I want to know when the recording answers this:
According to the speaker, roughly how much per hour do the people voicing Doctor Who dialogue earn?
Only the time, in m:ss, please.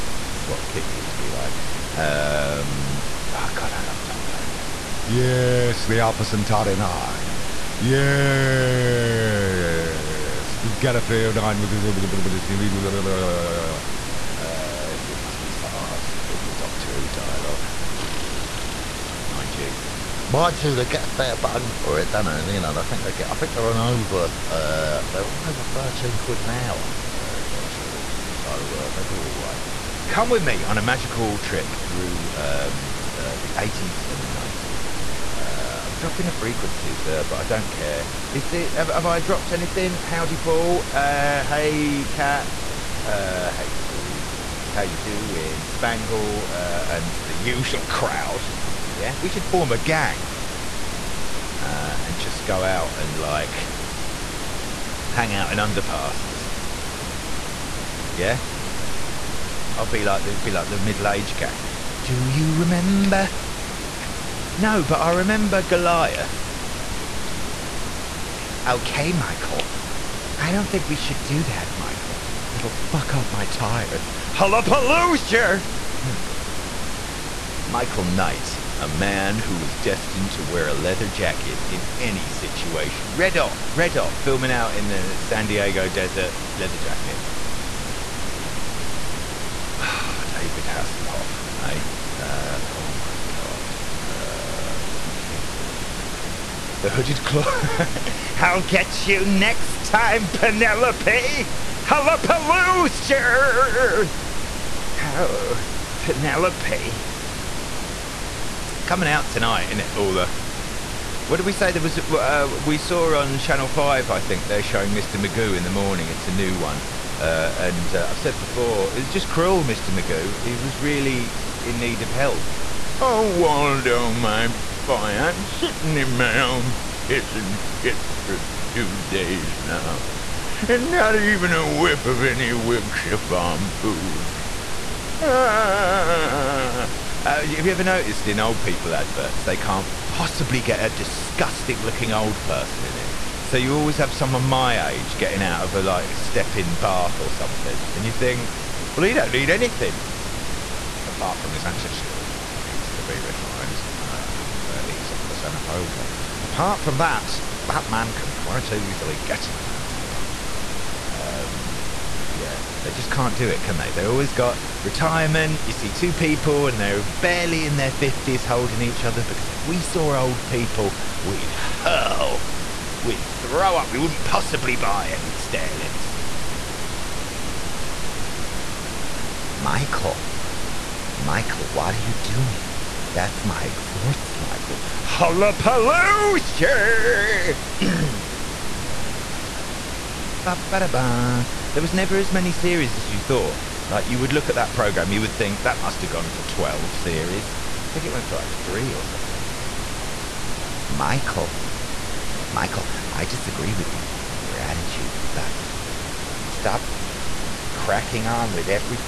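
0:25.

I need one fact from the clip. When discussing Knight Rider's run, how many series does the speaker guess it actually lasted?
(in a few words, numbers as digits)
3.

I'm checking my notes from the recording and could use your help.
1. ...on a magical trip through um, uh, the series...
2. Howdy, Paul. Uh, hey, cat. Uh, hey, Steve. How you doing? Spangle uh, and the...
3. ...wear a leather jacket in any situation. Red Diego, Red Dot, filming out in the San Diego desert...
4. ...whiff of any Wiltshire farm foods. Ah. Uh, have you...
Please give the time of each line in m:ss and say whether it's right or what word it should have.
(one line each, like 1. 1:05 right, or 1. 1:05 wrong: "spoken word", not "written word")
1. 0:30 wrong: "eighties", not "series"
2. 0:40 right
3. 1:20 wrong: "Dot", not "Diego"
4. 2:11 right.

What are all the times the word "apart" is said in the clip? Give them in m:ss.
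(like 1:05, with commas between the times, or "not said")
2:31, 2:36.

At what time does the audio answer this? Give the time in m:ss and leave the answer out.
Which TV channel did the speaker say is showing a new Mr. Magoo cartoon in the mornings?
1:53.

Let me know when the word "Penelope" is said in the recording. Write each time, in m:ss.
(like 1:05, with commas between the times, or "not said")
1:40, 1:45.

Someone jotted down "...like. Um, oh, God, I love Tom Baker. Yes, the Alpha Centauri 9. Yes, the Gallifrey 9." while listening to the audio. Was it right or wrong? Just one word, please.
right.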